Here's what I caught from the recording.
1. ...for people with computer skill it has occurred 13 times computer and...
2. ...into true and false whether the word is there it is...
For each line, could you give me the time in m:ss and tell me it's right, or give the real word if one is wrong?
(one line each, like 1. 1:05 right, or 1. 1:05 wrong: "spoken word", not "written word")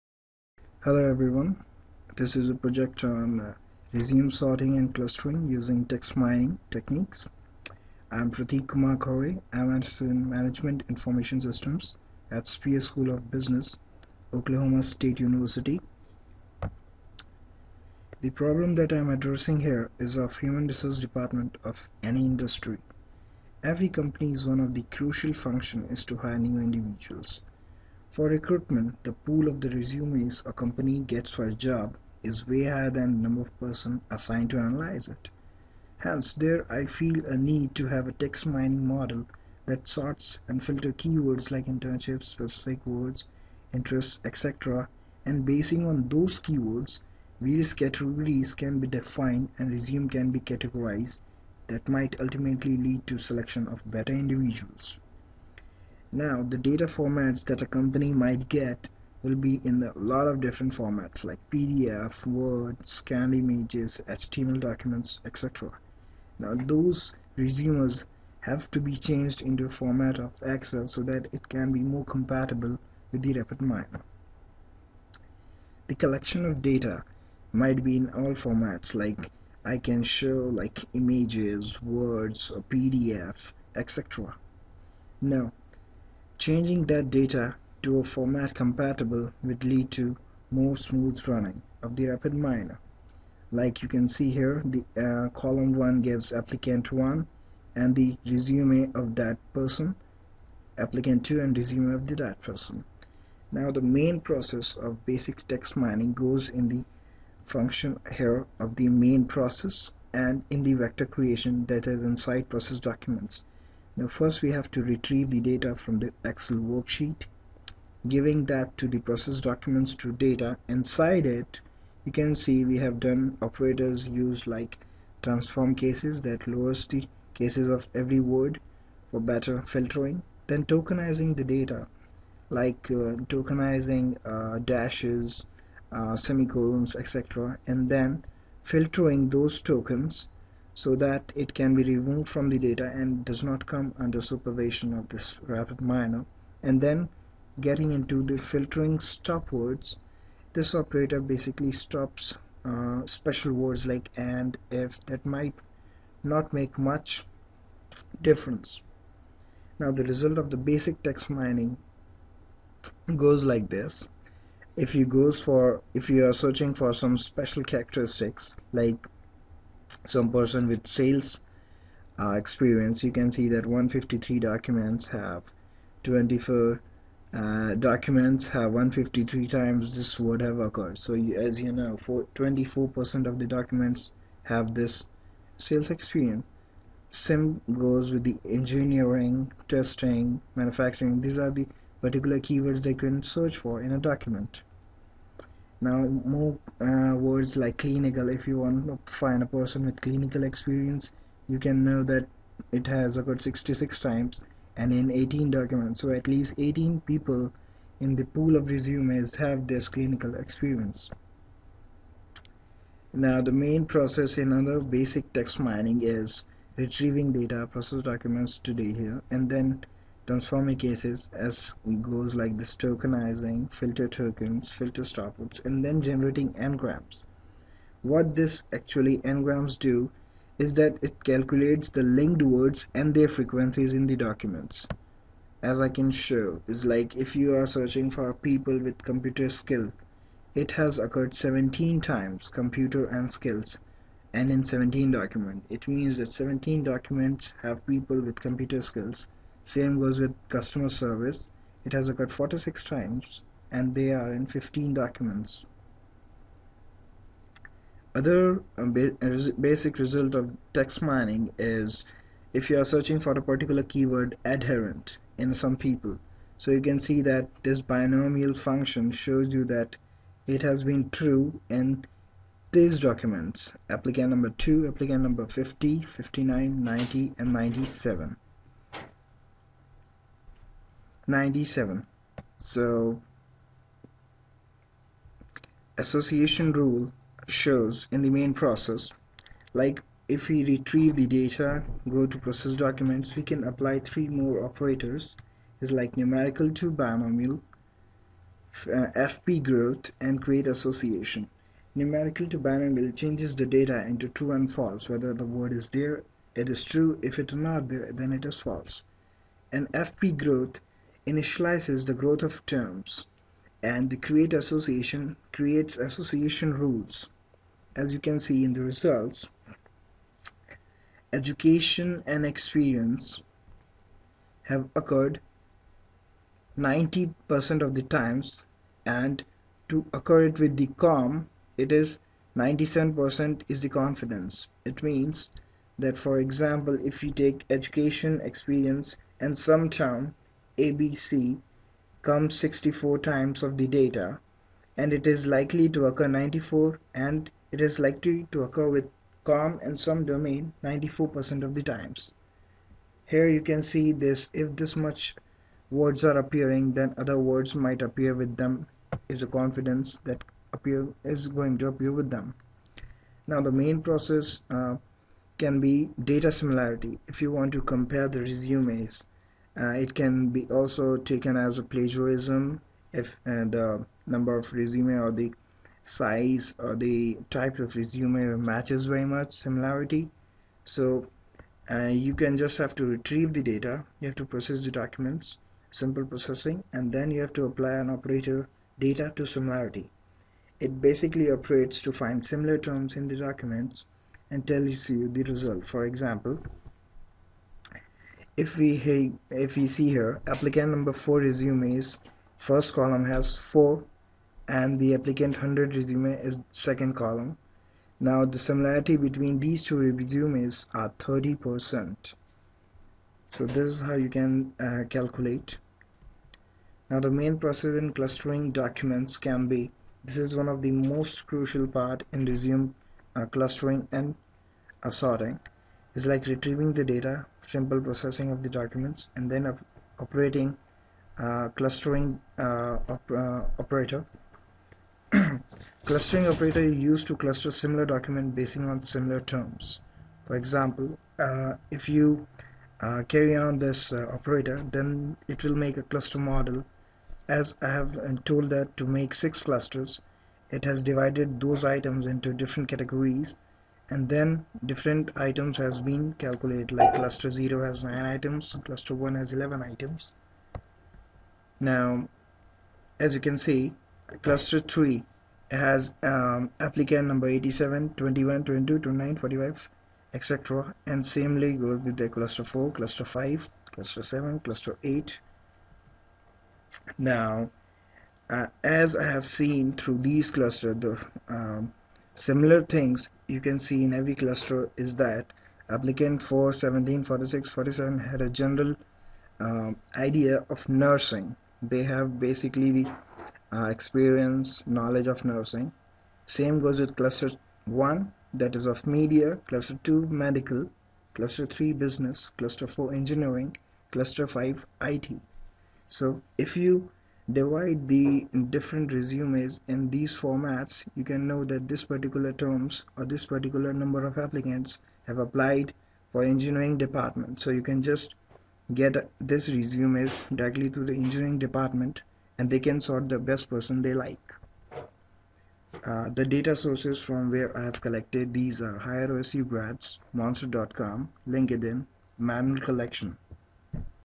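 1. 3:58 wrong: "17", not "13"
2. 5:04 right.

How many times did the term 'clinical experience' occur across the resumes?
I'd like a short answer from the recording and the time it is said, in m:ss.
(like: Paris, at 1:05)
66, at 3:23.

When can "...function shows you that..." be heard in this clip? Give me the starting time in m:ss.
4:28.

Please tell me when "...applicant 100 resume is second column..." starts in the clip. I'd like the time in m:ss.
6:45.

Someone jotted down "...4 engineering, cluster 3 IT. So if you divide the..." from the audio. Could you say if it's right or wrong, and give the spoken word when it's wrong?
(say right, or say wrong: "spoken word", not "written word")
wrong: "5", not "3".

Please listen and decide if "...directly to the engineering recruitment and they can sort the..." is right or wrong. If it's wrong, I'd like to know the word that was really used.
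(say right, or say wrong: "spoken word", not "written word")
wrong: "department", not "recruitment".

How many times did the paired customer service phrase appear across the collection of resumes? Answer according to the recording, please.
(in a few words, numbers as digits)
46.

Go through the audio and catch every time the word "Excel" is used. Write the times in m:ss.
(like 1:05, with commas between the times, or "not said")
1:10, 1:56.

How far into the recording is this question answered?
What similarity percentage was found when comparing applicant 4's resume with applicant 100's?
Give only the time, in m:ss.
6:51.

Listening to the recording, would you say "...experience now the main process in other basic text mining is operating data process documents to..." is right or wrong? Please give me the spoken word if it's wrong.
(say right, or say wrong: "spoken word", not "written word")
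wrong: "retrieving", not "operating".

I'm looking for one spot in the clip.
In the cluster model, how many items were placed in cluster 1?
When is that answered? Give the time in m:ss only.
7:39.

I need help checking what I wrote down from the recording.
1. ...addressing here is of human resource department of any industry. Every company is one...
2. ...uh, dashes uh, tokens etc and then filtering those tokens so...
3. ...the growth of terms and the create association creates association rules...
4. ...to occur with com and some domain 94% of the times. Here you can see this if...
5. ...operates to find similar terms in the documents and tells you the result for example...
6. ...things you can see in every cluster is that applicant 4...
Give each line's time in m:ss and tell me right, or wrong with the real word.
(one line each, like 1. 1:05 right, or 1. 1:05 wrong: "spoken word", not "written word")
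1. 0:19 right
2. 2:14 wrong: "semicolons", not "tokens"
3. 5:12 right
4. 5:48 right
5. 6:31 right
6. 8:02 right.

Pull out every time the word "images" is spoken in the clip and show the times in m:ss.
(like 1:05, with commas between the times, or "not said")
1:03, 1:20.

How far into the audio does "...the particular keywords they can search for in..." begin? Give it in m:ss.
3:11.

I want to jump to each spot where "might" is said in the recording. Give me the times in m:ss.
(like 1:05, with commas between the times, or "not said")
0:51, 0:58, 1:17, 2:35, 5:57.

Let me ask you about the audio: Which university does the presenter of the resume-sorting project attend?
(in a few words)
Oklahoma State University.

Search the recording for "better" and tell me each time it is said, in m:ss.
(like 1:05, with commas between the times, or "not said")
0:53, 2:09.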